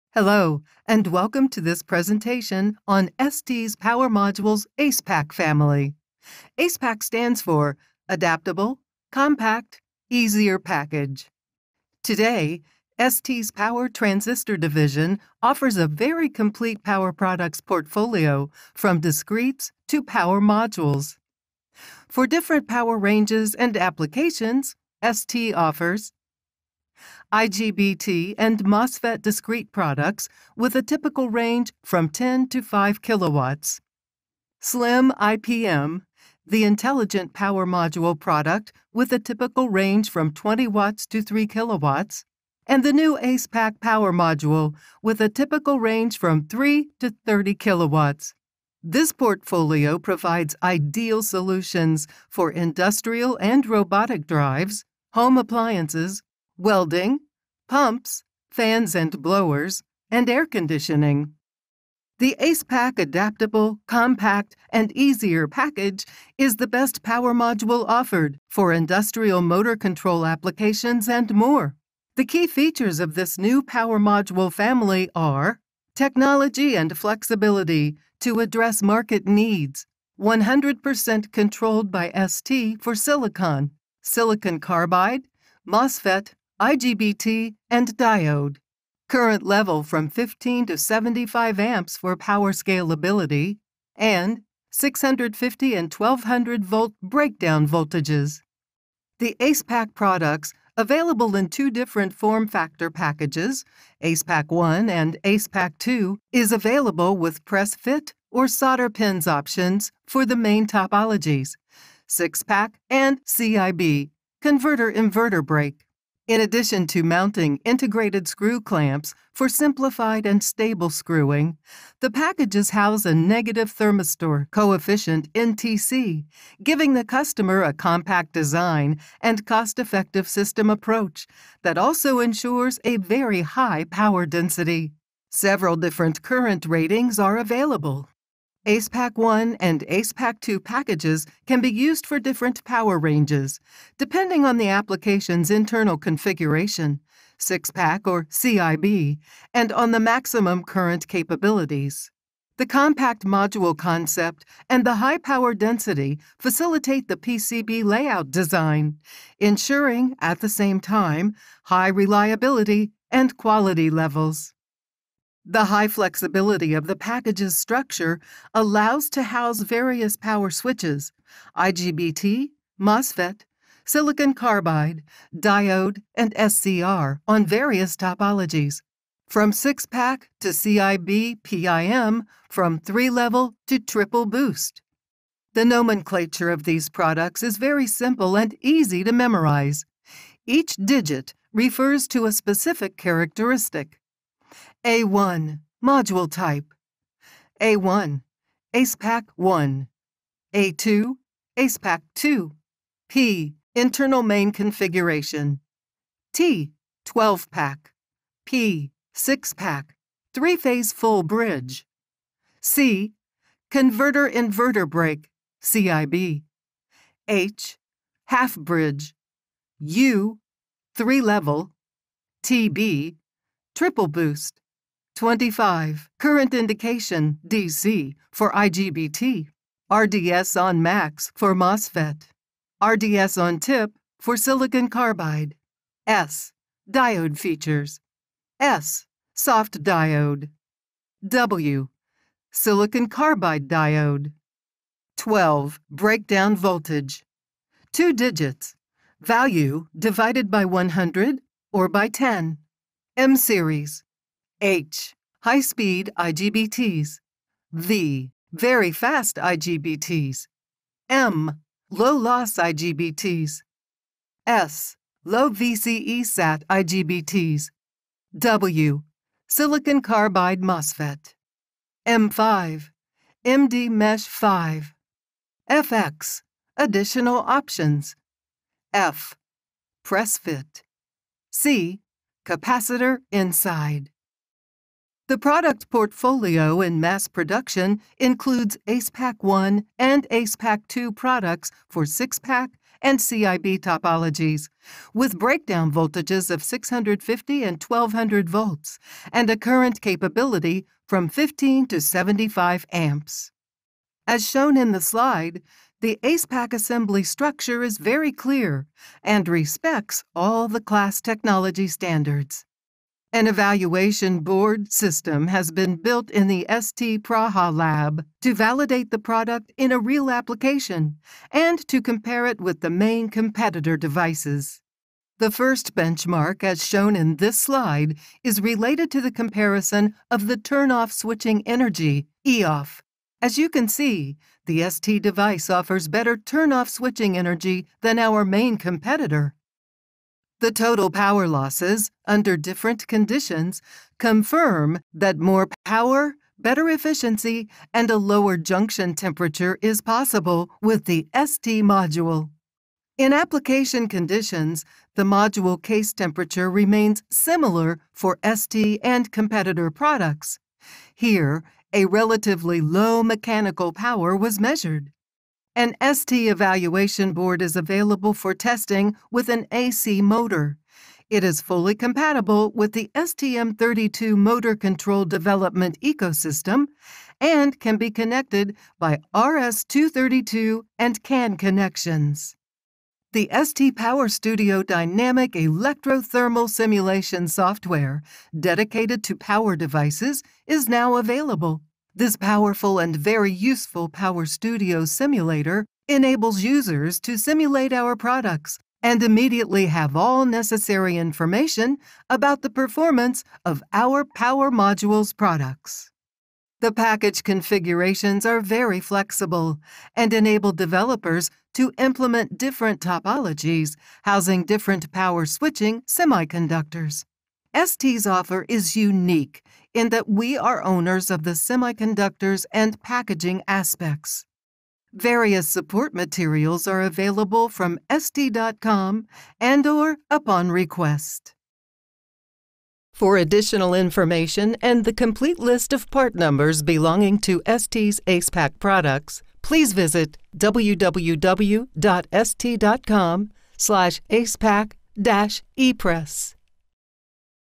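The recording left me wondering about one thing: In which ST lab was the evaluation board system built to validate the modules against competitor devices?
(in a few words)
ST Praha lab.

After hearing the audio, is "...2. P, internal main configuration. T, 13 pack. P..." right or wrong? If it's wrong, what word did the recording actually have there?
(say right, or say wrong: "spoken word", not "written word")
wrong: "12", not "13".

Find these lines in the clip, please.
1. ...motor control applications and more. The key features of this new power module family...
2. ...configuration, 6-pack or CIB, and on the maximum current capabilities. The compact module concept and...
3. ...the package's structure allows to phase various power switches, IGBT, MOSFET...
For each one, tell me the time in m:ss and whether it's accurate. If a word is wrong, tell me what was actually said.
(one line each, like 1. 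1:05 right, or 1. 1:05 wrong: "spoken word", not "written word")
1. 1:09 right
2. 2:25 right
3. 2:46 wrong: "house", not "phase".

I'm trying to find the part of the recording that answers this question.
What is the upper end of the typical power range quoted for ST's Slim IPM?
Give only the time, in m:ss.
0:41.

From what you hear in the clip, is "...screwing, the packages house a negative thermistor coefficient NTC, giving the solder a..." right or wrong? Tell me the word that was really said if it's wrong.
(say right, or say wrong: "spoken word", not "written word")
wrong: "customer", not "solder".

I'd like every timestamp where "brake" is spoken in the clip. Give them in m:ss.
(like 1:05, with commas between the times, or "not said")
1:55, 3:34.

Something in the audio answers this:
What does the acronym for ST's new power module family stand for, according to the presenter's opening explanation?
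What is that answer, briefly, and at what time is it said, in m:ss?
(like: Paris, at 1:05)
Adaptable, Compact, Easier Package, at 0:08.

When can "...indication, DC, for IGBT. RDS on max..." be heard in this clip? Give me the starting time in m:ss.
3:46.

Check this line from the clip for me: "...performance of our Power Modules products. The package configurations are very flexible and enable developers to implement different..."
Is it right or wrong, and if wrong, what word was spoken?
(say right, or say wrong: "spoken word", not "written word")
right.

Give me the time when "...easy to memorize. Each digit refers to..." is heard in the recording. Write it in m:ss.
3:08.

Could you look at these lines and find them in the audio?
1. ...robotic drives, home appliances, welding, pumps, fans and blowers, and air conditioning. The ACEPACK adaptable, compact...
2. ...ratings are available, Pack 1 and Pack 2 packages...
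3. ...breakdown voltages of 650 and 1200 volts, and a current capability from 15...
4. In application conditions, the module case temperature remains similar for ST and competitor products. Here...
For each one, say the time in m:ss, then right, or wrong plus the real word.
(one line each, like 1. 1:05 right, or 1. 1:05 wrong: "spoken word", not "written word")
1. 0:53 right
2. 2:16 right
3. 4:55 right
4. 5:53 right.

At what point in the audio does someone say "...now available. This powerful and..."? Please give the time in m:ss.
6:30.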